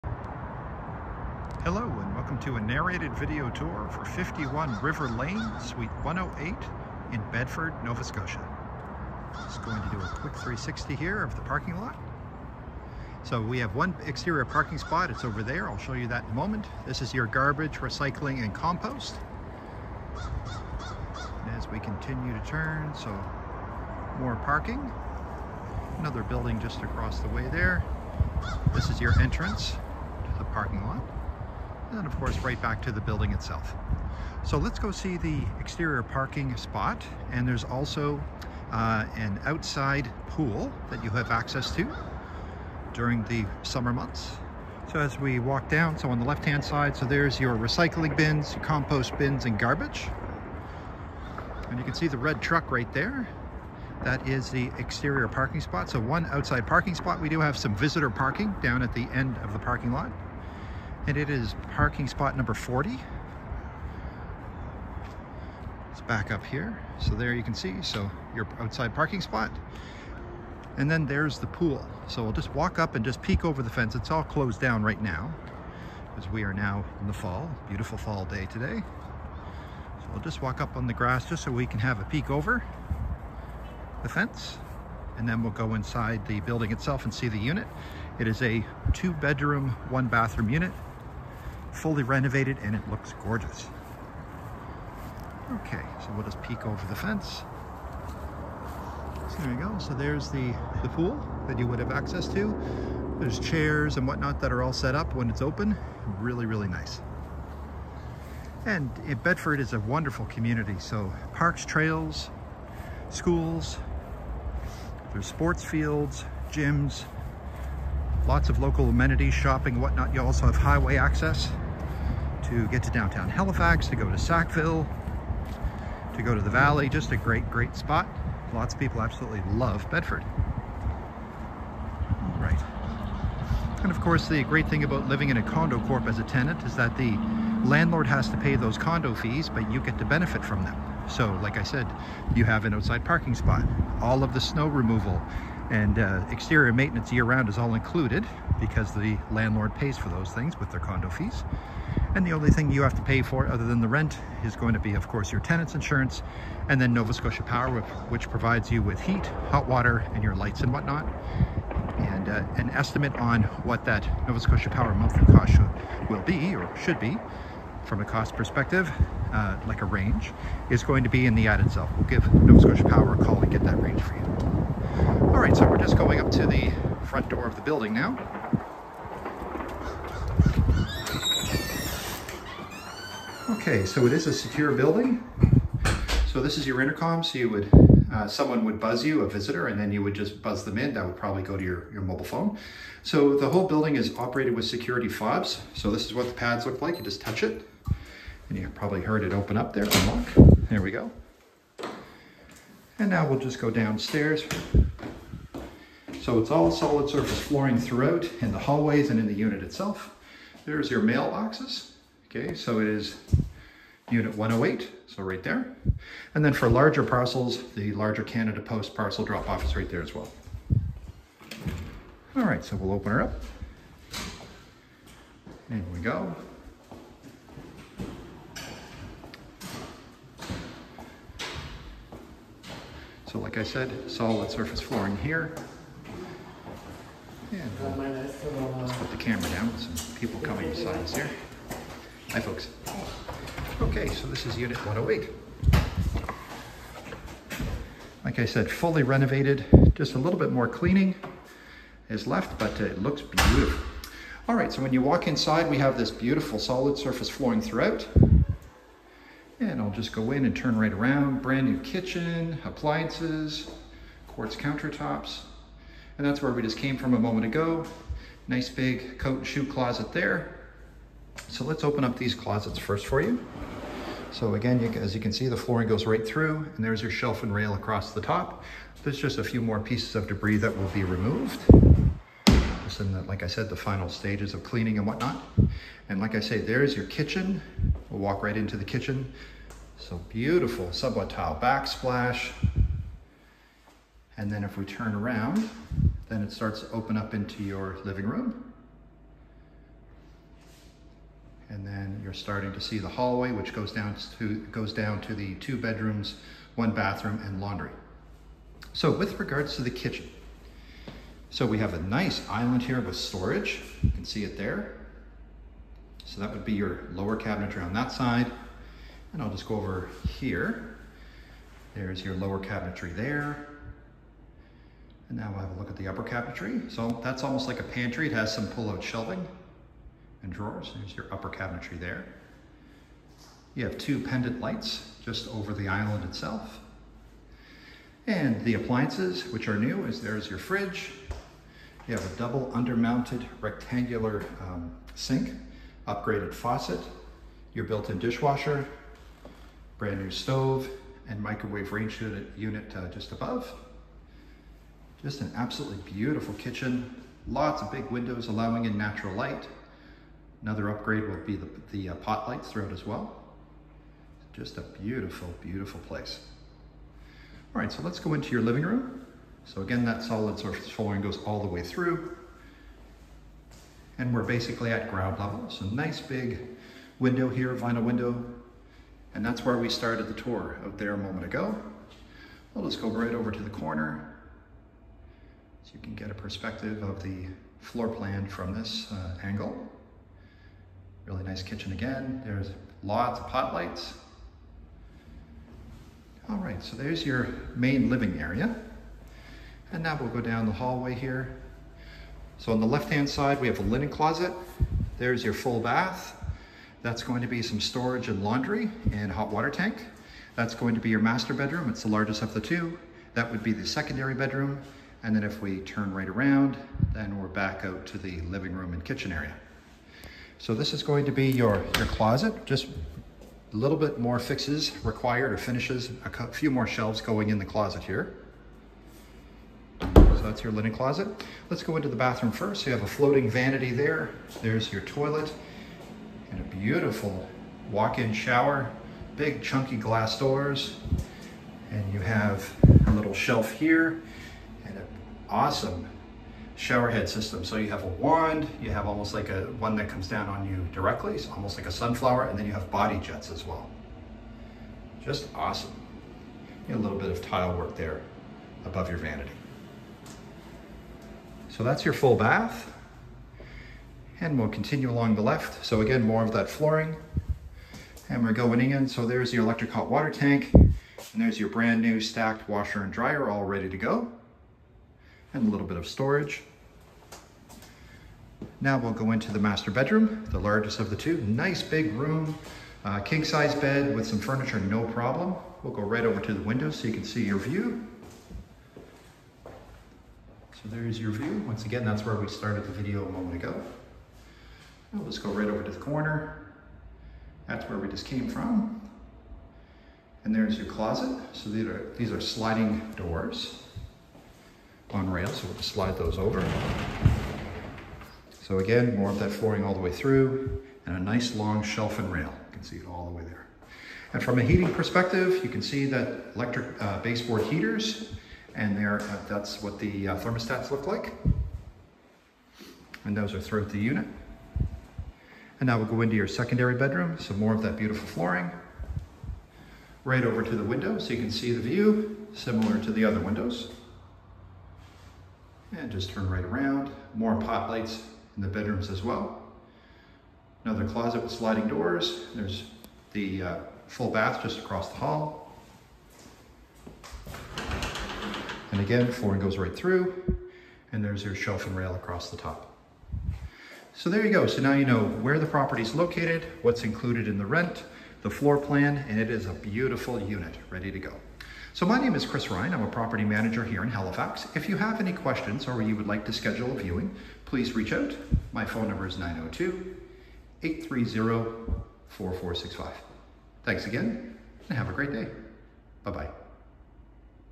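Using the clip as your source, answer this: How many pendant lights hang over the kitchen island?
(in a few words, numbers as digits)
2.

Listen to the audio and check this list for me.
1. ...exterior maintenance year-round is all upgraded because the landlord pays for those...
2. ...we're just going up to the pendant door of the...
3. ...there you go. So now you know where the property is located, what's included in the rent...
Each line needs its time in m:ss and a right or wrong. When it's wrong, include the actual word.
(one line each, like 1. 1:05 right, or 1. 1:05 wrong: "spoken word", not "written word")
1. 2:26 wrong: "included", not "upgraded"
2. 2:55 wrong: "front", not "pendant"
3. 9:14 right.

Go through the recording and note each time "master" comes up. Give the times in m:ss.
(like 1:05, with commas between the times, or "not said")
6:51, 7:59.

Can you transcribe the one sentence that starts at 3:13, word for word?
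So the whole building is operated with security fobs.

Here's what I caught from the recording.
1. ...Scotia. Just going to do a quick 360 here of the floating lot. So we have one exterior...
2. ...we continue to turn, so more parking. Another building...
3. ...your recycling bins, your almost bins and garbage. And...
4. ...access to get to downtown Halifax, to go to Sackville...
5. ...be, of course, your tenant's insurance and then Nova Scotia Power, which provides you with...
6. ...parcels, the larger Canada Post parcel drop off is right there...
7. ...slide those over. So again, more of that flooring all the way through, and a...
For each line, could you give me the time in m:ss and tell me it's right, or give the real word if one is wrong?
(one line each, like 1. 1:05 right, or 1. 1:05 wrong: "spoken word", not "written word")
1. 0:08 wrong: "parking", not "floating"
2. 0:21 right
3. 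0:47 wrong: "compost", not "almost"
4. 2:00 right
5. 2:34 right
6. 3:37 right
7. 8:25 right.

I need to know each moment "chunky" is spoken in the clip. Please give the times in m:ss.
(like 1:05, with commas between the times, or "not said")
7:19.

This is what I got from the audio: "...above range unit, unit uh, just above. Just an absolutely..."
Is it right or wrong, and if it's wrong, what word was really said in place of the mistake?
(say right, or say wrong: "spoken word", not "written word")
wrong: "microwave", not "above".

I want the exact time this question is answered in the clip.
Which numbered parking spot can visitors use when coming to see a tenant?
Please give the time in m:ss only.
1:02.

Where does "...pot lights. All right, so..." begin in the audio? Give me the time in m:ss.
6:33.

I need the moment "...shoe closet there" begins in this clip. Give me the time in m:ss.
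4:29.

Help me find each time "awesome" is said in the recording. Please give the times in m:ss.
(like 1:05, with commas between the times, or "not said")
7:25, 7:35.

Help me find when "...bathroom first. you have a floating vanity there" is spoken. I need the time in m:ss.
7:12.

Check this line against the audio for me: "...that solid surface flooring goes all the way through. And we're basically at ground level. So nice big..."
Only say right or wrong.
right.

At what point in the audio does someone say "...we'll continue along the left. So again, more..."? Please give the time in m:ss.
7:44.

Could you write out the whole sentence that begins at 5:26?
So that's almost like a pantry.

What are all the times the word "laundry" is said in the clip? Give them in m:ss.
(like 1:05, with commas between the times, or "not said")
5:07, 6:48.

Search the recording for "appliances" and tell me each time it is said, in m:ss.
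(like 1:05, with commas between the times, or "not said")
4:22, 5:38.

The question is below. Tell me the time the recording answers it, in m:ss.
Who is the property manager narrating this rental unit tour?
9:22.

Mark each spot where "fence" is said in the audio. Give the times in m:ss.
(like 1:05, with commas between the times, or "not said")
1:13, 1:24, 1:36.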